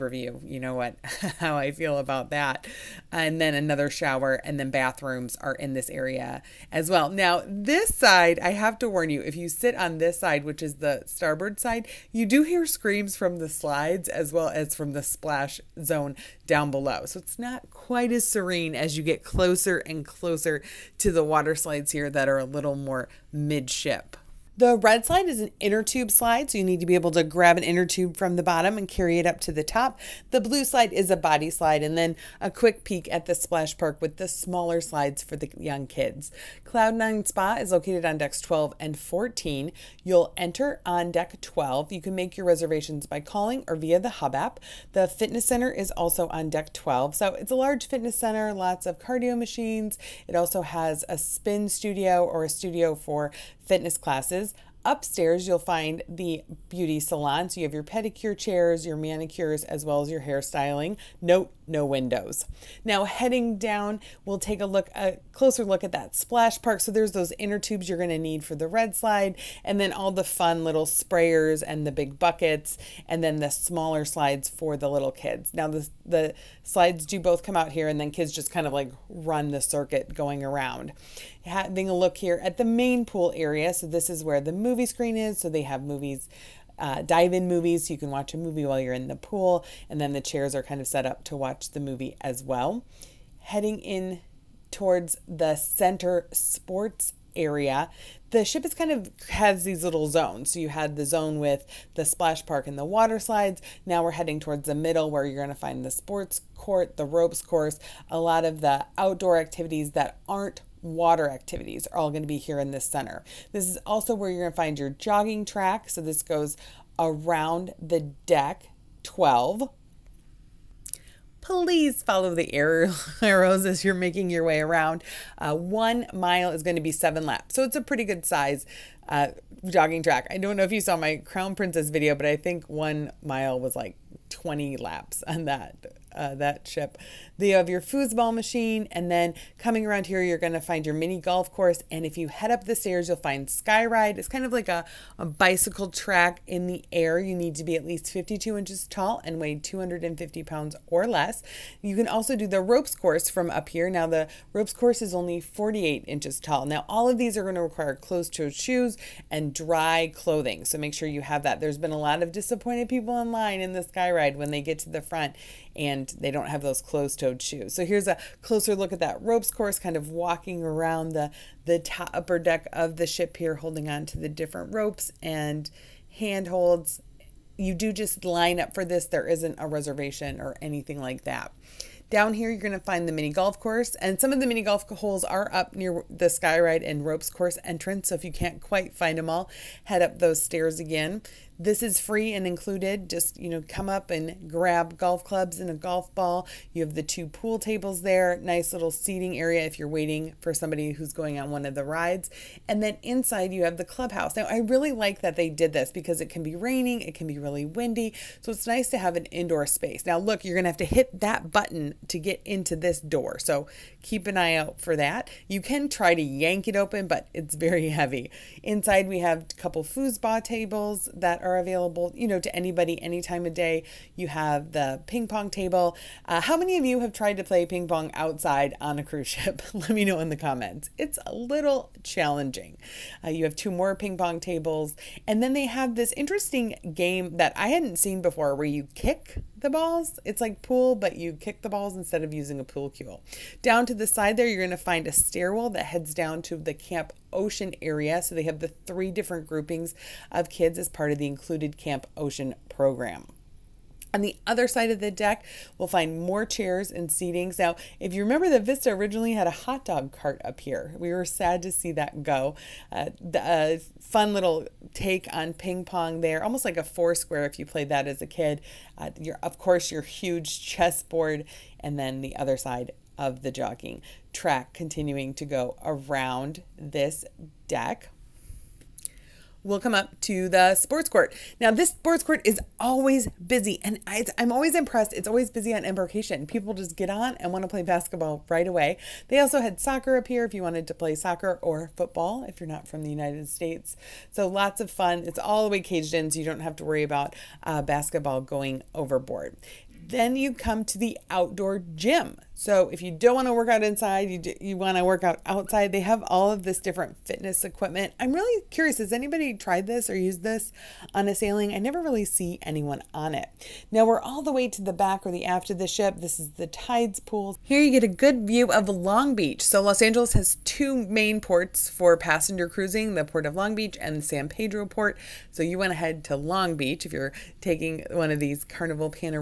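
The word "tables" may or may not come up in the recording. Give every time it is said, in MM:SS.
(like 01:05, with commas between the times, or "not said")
03:17, 03:40, 03:45, 03:54.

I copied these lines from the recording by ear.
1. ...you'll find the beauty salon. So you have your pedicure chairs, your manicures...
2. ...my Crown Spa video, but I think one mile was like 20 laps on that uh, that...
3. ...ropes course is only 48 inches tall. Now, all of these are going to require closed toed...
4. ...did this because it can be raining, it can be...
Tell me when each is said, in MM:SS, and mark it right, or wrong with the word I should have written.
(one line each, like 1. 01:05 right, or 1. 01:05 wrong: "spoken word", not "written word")
1. 00:55 right
2. 02:10 wrong: "Princess", not "Spa"
3. 02:34 right
4. 03:25 right.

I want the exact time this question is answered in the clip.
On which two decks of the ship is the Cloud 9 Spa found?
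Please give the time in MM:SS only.
00:38.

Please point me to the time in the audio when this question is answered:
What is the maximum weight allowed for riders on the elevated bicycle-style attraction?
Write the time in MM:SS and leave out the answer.
02:29.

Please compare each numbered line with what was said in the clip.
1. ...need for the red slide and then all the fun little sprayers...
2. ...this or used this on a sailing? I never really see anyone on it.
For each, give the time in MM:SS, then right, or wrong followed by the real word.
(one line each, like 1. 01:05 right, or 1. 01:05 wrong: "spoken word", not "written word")
1. 01:08 right
2. 05:09 right.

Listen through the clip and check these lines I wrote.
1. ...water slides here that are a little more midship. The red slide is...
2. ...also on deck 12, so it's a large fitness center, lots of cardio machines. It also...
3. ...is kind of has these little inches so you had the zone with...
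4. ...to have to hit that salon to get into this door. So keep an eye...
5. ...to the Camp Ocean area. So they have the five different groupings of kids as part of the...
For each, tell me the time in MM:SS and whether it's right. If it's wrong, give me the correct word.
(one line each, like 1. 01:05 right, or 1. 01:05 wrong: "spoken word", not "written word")
1. 00:21 right
2. 00:45 right
3. 01:38 wrong: "zones", not "inches"
4. 03:30 wrong: "button", not "salon"
5. 04:06 wrong: "three", not "five".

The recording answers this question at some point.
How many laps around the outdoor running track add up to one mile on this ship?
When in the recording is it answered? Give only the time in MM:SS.
02:06.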